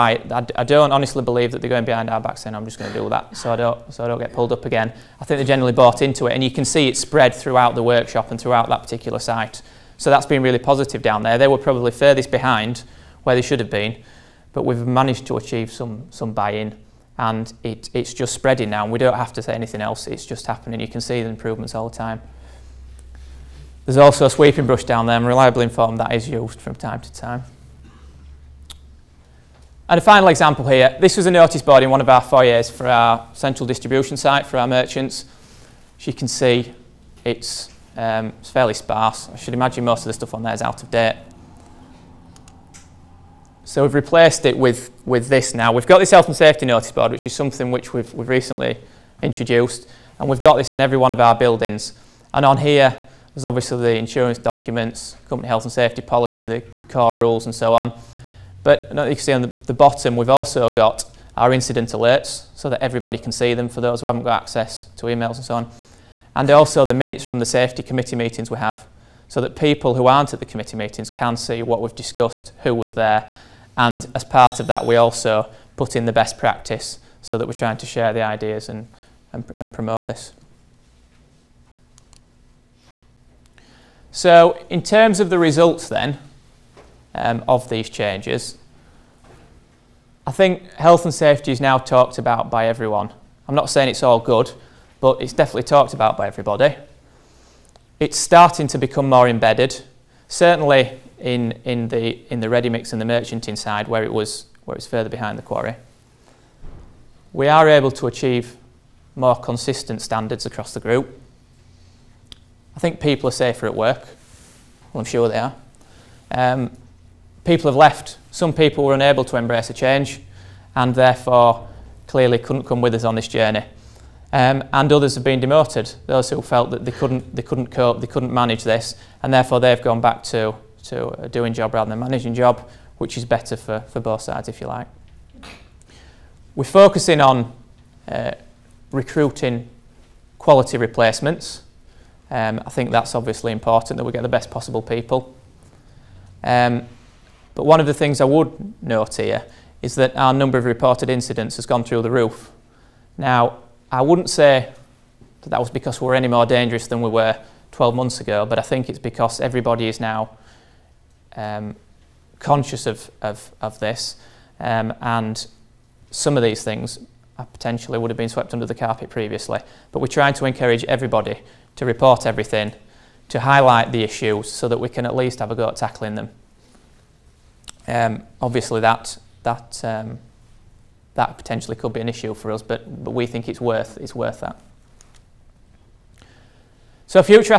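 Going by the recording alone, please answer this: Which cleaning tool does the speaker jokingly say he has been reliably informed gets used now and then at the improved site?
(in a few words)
sweeping brush.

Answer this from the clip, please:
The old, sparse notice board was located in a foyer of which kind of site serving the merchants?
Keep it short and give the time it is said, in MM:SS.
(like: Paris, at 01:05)
central distribution site, at 00:33.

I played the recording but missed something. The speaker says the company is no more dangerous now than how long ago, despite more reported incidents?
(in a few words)
12 months ago.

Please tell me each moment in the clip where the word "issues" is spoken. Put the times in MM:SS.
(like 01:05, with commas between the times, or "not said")
02:54, 03:02.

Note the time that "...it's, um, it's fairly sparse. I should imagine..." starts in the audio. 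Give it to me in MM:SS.
00:37.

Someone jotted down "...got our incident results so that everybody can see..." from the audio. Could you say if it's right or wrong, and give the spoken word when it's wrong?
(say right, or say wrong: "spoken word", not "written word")
wrong: "alerts", not "results".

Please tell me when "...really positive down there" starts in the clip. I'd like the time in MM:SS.
00:10.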